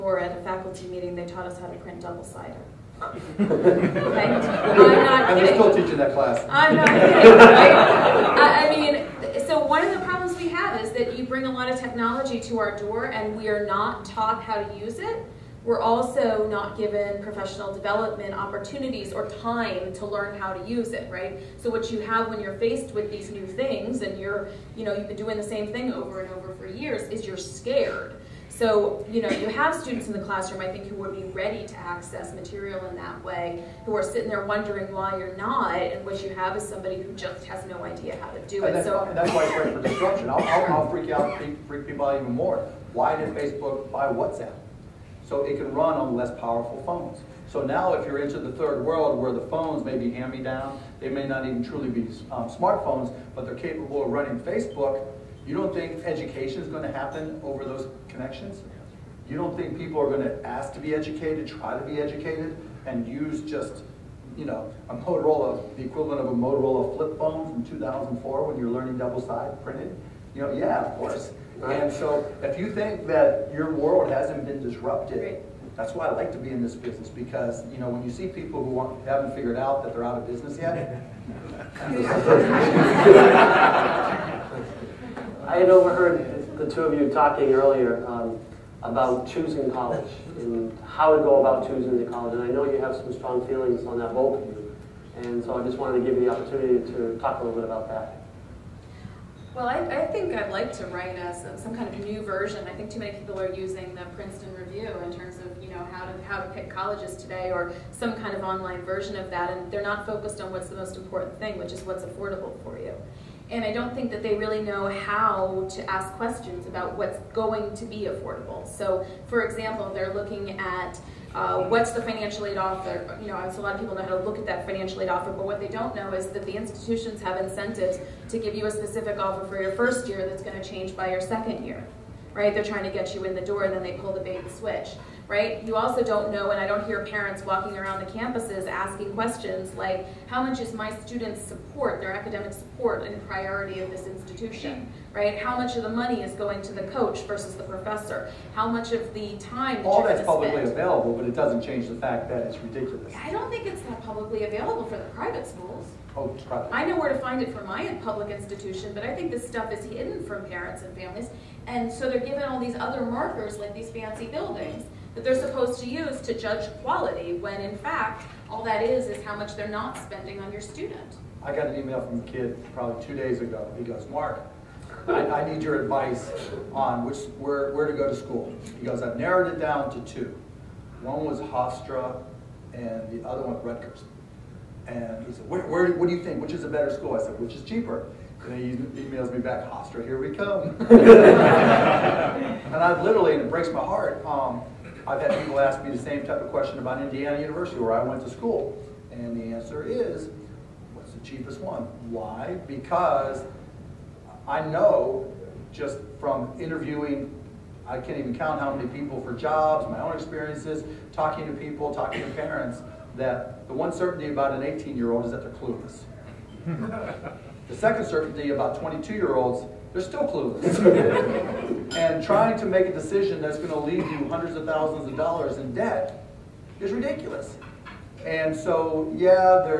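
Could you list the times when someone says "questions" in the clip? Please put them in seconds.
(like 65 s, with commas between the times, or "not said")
116 s, 139 s, 196 s.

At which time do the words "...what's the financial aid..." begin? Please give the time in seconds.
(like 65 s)
121 s.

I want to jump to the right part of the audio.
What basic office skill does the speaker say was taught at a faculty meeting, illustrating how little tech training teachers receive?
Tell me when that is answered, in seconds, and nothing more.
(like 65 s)
1 s.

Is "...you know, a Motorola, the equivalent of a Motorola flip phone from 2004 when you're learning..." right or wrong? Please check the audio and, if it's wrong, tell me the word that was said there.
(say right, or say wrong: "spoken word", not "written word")
right.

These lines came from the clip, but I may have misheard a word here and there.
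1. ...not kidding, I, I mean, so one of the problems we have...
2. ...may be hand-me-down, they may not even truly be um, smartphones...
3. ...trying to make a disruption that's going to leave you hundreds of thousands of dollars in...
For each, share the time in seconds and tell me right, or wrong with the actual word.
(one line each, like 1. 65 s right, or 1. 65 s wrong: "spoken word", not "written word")
1. 6 s right
2. 49 s right
3. 222 s wrong: "decision", not "disruption".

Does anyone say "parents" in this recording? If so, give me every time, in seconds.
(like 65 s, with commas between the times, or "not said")
137 s, 160 s, 212 s.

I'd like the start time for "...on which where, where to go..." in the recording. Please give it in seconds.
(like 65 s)
176 s.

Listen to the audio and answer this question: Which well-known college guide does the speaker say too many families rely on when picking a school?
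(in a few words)
Princeton Review.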